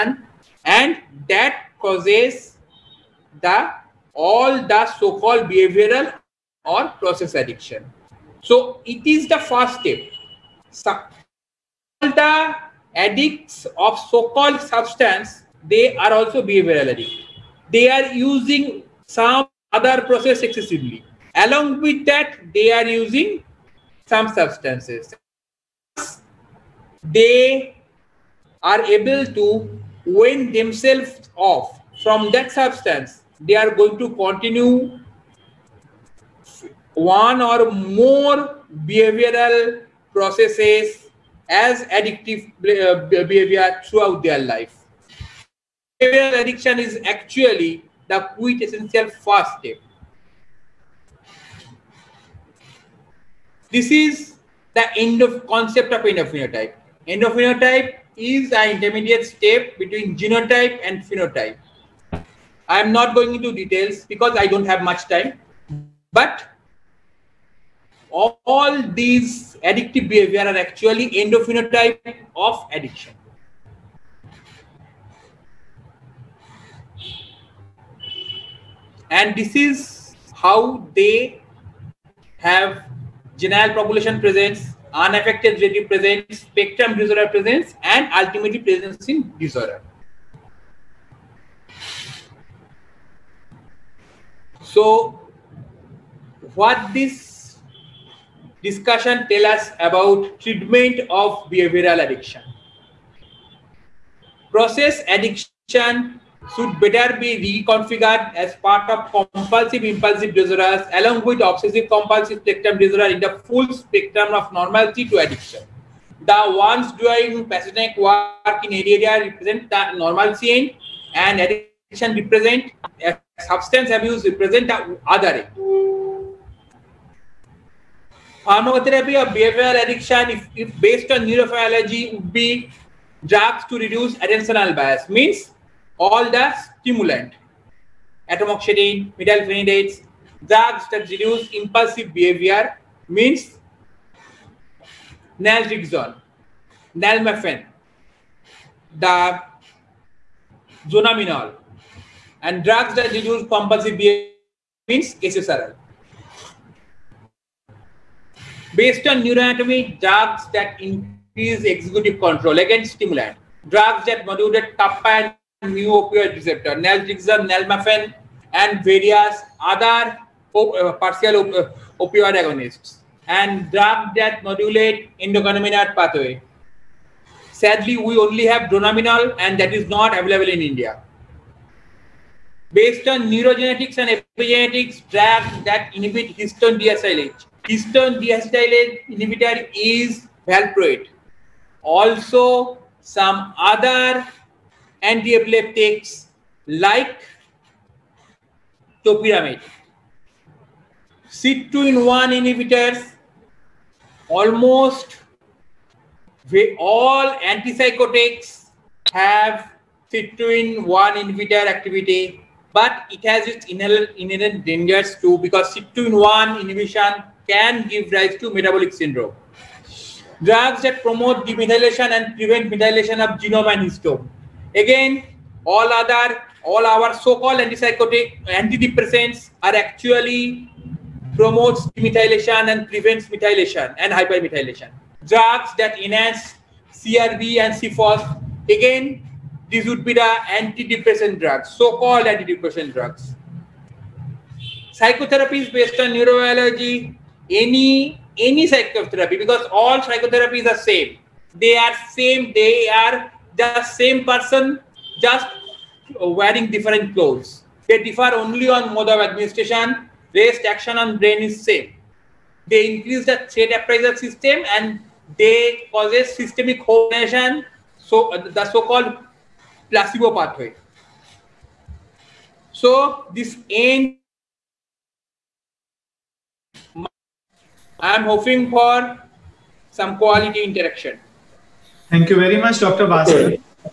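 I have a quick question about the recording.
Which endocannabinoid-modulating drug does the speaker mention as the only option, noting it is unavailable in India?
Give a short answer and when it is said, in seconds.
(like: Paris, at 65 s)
Dronabinol, at 178 s.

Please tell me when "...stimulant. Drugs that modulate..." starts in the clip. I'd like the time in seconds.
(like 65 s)
162 s.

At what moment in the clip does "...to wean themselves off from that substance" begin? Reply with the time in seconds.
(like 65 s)
29 s.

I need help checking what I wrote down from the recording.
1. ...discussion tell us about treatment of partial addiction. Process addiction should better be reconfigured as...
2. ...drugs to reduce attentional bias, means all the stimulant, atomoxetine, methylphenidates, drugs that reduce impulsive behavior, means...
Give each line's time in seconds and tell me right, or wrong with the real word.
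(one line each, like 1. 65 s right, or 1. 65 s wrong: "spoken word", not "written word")
1. 98 s wrong: "behavioral", not "partial"
2. 133 s right.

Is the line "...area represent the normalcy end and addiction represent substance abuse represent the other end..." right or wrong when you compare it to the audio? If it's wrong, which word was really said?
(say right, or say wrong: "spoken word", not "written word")
right.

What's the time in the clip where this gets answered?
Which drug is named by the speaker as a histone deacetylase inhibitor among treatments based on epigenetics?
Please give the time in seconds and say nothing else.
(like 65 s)
190 s.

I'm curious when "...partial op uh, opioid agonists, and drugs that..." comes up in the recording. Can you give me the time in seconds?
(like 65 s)
171 s.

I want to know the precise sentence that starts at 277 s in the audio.
I am hoping for some quality interaction.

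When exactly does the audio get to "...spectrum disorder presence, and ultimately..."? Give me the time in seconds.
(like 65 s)
86 s.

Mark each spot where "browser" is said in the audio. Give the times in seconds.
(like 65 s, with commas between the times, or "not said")
not said.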